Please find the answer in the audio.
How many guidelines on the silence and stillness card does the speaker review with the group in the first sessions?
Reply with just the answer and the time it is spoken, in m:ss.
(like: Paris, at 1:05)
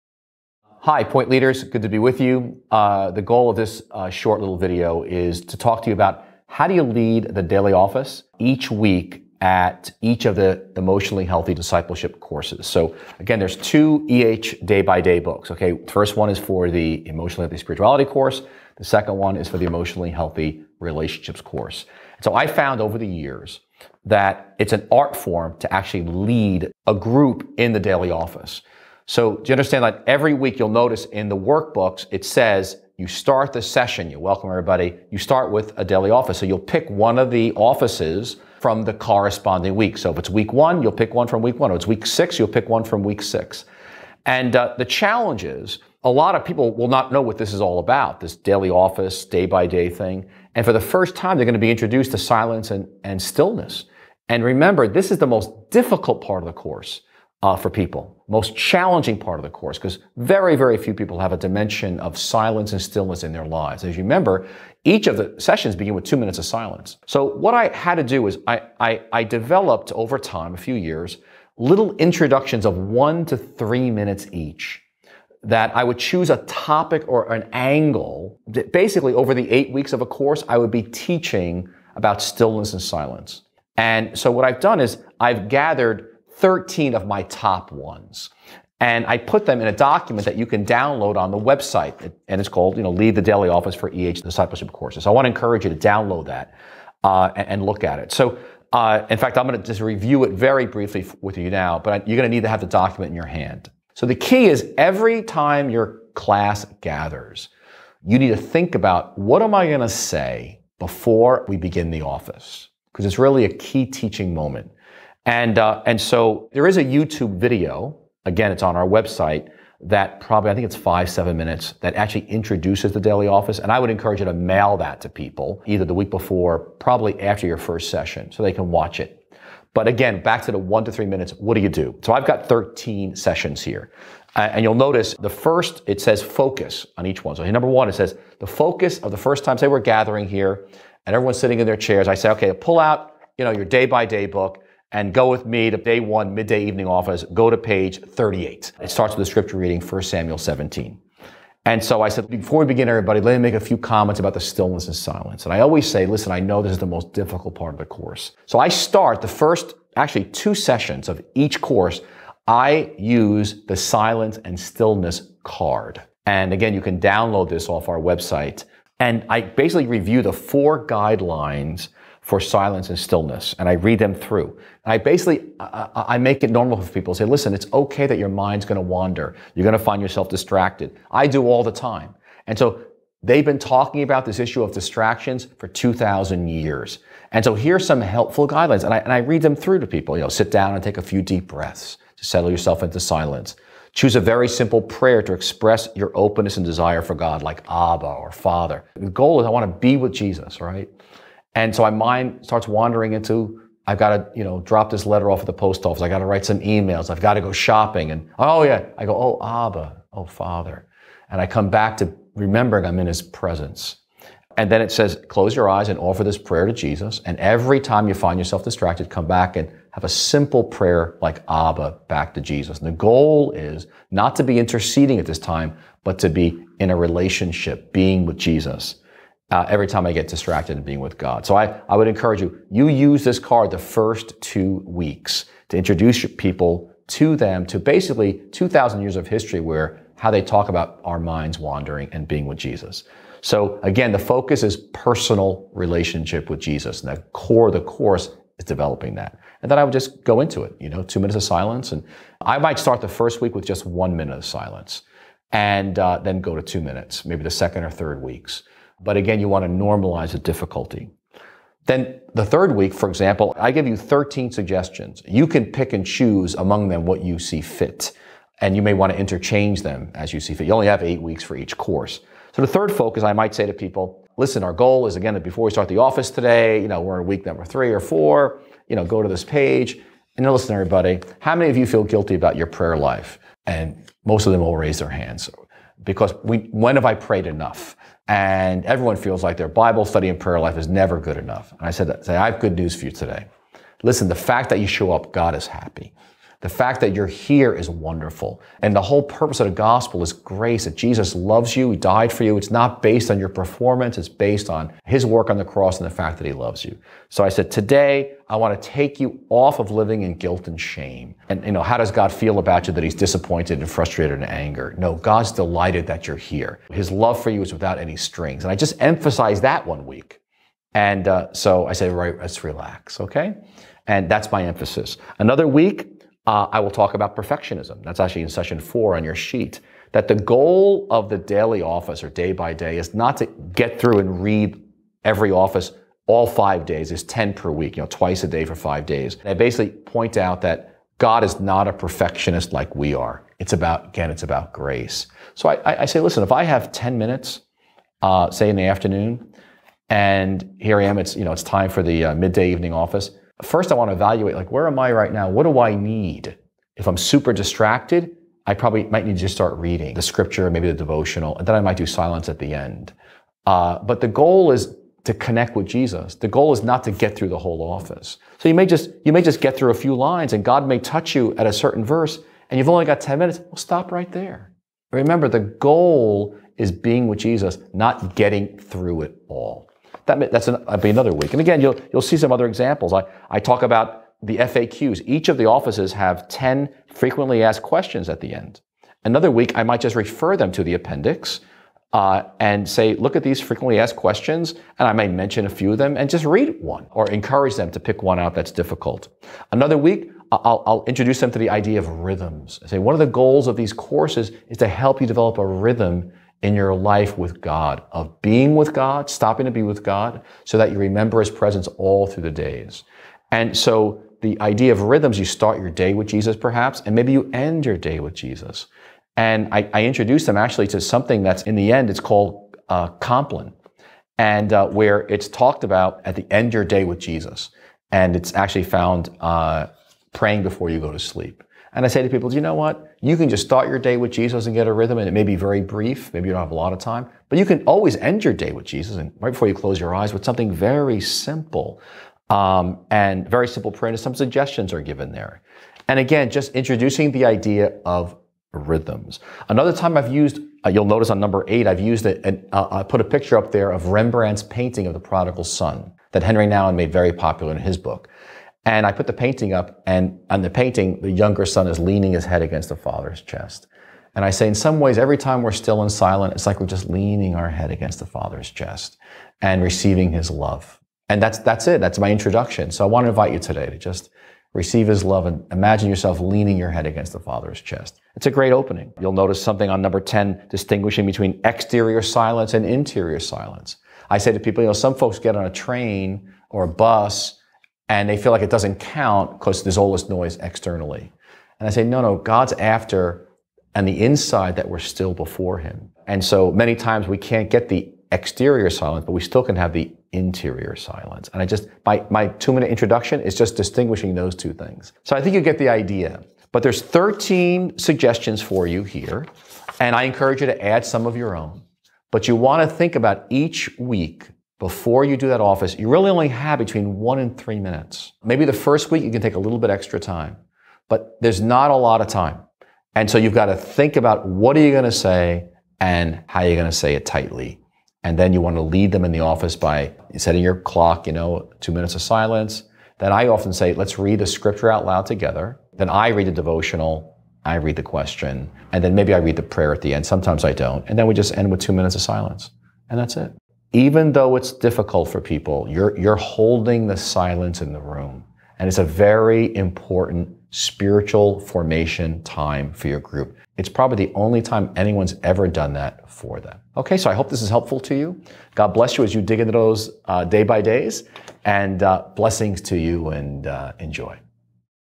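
4, at 2:50.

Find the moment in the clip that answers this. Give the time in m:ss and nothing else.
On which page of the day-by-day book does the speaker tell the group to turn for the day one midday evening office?
2:27.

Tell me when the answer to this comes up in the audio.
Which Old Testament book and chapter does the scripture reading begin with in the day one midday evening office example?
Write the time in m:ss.
2:29.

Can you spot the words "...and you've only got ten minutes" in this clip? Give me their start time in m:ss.
6:12.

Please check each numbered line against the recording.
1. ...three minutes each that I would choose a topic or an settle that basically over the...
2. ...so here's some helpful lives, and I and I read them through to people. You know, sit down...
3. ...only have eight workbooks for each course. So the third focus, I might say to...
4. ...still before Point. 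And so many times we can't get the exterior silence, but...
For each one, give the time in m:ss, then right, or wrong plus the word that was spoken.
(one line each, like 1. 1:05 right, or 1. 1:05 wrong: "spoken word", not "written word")
1. 1:13 wrong: "angle", not "settle"
2. 3:07 wrong: "guidelines", not "lives"
3. 4:30 wrong: "weeks", not "workbooks"
4. 8:14 wrong: "Him", not "Point".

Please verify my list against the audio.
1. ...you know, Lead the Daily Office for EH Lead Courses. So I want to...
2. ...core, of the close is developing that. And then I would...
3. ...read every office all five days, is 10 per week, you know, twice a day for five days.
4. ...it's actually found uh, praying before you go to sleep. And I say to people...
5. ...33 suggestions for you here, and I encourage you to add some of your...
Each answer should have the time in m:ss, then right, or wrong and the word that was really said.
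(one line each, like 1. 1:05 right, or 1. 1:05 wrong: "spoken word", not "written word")
1. 1:32 wrong: "Discipleship", not "Lead"
2. 4:07 wrong: "course", not "close"
3. 5:34 right
4. 7:08 right
5. 8:27 wrong: "13", not "33".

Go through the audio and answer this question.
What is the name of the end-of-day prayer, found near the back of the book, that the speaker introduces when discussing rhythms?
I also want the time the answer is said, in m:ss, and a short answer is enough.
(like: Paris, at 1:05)
Compline, at 7:03.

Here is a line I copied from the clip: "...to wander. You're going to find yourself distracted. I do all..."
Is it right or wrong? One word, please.
right.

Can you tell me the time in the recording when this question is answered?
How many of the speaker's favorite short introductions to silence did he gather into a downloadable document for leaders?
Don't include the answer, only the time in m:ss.
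1:26.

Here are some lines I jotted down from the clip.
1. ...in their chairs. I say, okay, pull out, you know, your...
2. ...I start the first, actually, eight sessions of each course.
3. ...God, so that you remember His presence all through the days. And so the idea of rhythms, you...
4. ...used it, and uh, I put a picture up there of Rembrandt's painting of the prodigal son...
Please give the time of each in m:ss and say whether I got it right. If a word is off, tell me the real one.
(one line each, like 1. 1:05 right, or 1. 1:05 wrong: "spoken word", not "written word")
1. 2:21 right
2. 2:38 wrong: "two", not "eight"
3. 6:50 right
4. 7:32 right.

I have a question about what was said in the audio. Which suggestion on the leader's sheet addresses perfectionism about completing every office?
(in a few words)
Session 4.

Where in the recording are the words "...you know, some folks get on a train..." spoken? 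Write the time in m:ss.
8:04.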